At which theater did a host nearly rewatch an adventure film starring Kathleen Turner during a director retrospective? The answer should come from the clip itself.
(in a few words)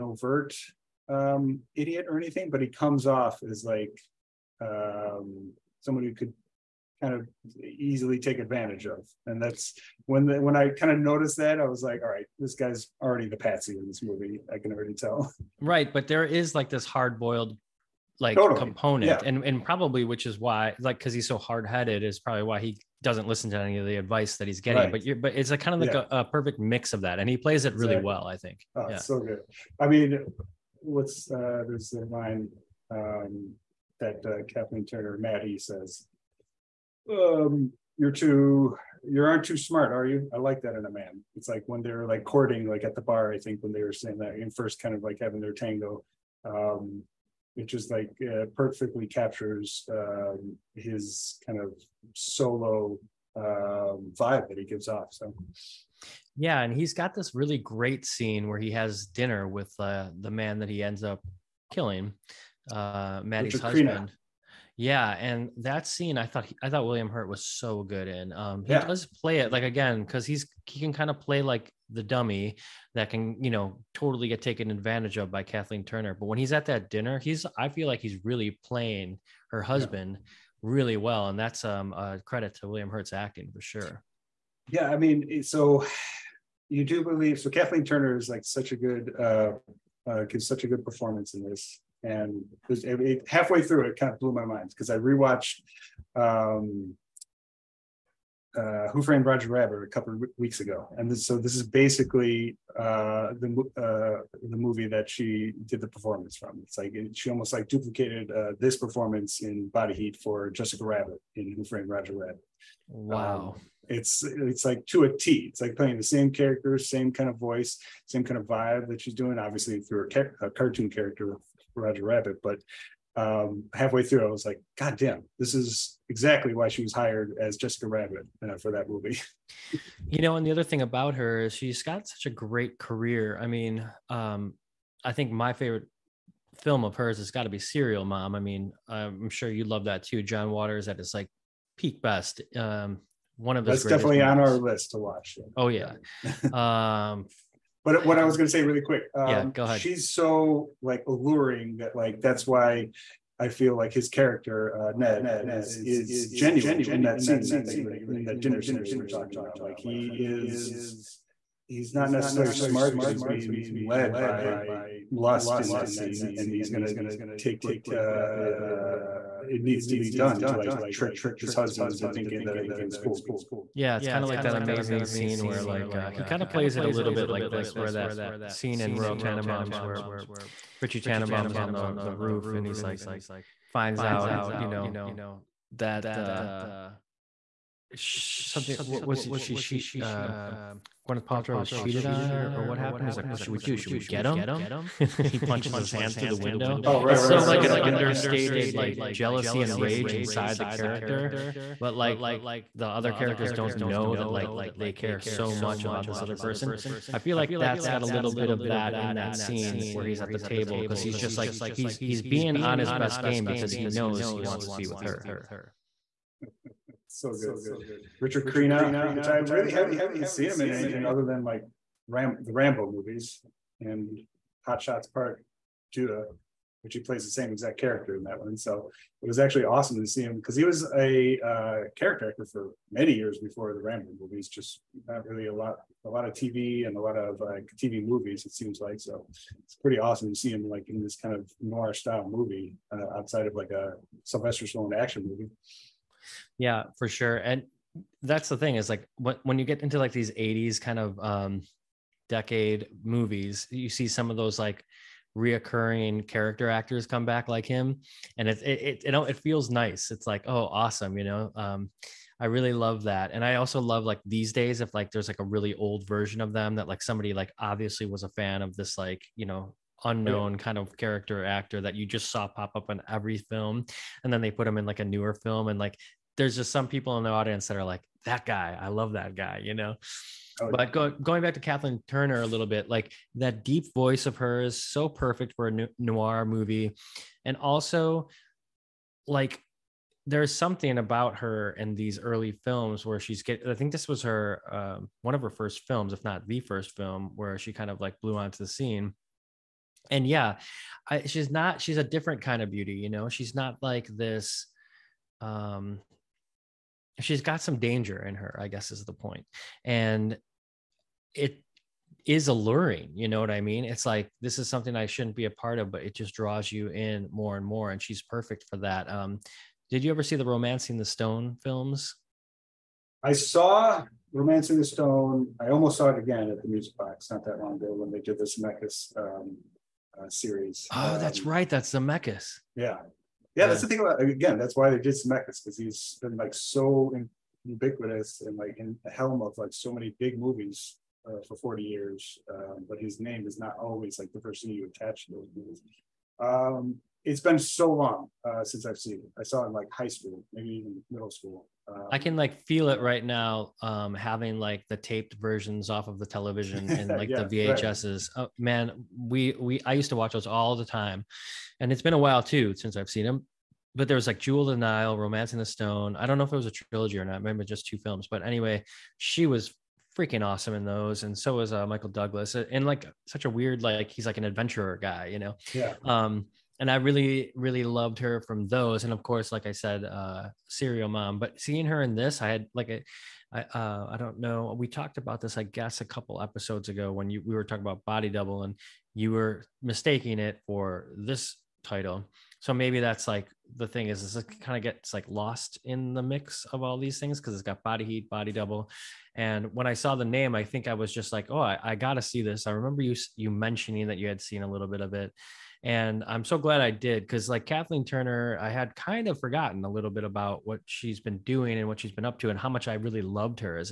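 Music Box.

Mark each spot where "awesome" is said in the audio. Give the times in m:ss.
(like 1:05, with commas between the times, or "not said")
3:49, 3:59, 4:20, 6:10.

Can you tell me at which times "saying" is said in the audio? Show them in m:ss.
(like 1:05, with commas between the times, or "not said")
0:43.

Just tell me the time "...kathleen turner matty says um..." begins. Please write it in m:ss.
0:34.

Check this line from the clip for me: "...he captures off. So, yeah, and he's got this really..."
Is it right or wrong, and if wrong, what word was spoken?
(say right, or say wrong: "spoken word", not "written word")
wrong: "gives", not "captures".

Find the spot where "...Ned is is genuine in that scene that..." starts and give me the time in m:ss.
2:34.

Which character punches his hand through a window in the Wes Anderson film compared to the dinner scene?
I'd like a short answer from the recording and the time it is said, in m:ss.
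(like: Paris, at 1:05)
Richie Tenenbaum, at 3:00.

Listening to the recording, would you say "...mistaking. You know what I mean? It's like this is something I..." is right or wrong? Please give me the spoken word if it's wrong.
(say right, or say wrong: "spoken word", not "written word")
wrong: "alluring", not "mistaking".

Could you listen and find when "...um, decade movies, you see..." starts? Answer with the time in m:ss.
4:11.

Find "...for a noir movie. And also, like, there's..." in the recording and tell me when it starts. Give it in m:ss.
4:45.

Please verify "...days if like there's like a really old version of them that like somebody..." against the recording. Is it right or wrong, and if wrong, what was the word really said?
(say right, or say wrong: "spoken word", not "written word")
right.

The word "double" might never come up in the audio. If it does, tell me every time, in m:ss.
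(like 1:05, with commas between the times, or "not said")
6:28, 6:38.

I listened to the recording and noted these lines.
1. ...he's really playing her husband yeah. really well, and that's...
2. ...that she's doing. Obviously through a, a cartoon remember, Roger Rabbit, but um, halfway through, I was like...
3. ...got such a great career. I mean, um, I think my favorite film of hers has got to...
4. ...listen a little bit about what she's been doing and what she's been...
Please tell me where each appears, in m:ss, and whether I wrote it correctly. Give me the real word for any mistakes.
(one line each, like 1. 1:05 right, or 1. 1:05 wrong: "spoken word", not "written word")
1. 1:17 right
2. 1:58 wrong: "character", not "remember"
3. 2:11 right
4. 6:49 wrong: "forgotten", not "listen".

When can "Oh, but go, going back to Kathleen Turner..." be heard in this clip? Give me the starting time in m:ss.
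4:40.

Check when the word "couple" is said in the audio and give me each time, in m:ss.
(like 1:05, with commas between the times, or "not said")
1:39, 6:26.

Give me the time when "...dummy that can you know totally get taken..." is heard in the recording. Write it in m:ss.
1:12.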